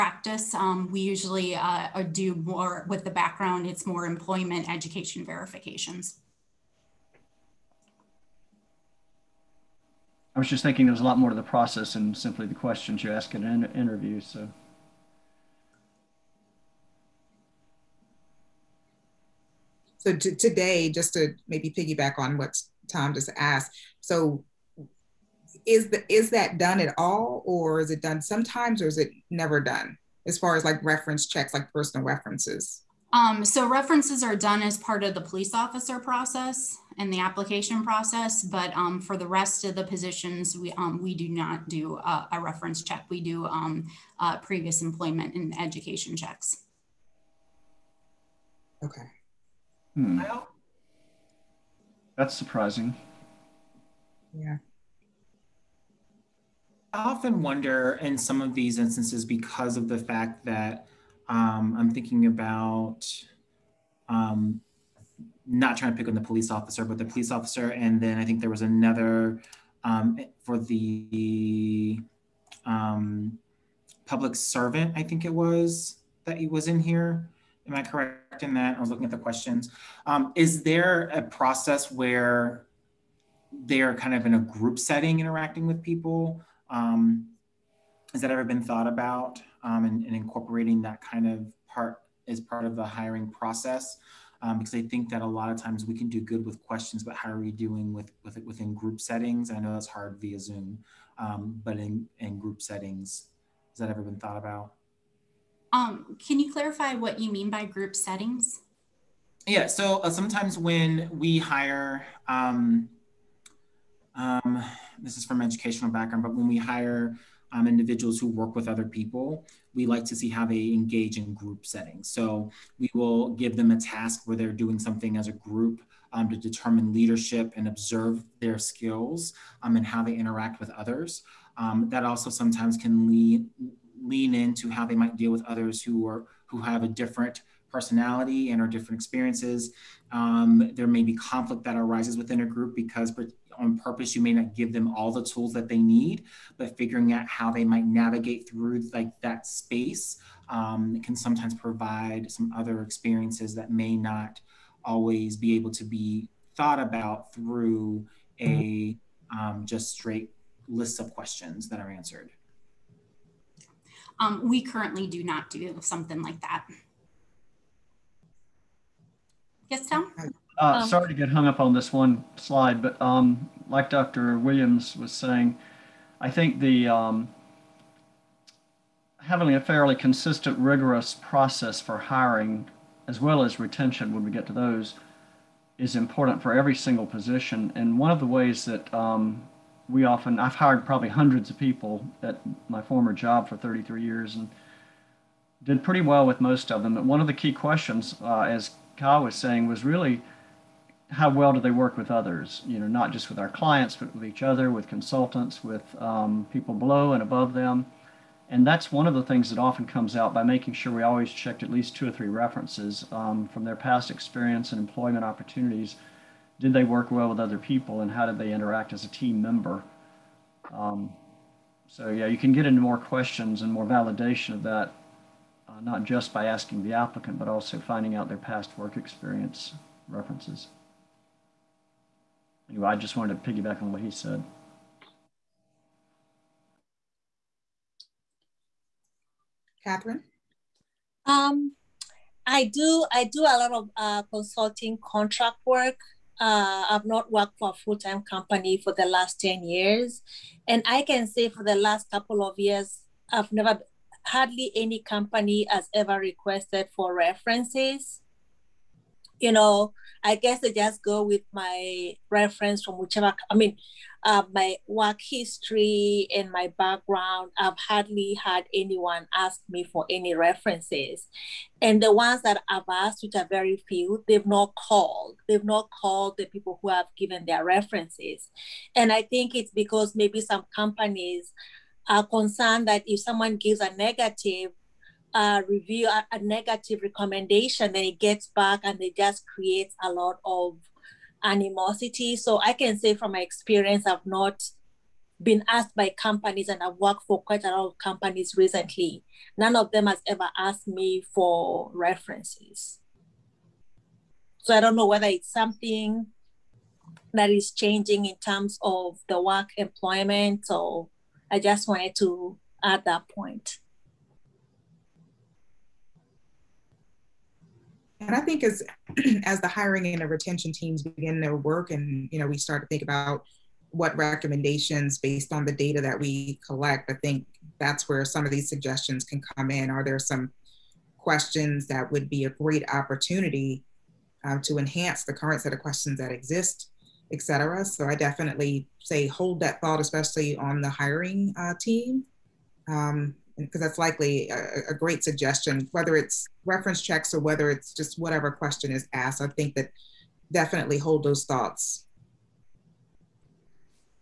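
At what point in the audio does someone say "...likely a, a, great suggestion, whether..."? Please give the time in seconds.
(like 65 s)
343 s.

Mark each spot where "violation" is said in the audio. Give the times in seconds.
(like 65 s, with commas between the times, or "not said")
not said.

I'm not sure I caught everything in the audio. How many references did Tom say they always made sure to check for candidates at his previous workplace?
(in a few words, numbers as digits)
2 or 3.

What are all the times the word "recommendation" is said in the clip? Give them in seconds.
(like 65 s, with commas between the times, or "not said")
287 s, 324 s.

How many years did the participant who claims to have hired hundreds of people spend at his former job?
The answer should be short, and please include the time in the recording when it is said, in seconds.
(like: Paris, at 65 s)
33, at 193 s.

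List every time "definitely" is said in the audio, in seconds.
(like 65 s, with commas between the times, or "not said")
338 s, 350 s.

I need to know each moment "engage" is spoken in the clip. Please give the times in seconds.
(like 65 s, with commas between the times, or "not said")
120 s.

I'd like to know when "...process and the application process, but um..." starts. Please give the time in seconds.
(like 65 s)
35 s.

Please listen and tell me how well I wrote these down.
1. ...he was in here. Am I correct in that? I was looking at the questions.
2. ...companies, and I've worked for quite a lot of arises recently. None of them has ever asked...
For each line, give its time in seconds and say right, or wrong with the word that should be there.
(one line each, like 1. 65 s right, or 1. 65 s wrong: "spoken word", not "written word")
1. 76 s right
2. 296 s wrong: "companies", not "arises".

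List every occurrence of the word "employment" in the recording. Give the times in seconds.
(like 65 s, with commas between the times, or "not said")
4 s, 44 s, 214 s, 309 s.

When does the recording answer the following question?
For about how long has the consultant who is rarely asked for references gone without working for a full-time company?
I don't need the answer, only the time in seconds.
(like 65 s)
249 s.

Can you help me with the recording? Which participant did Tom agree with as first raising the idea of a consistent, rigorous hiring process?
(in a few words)
Dr. Williams.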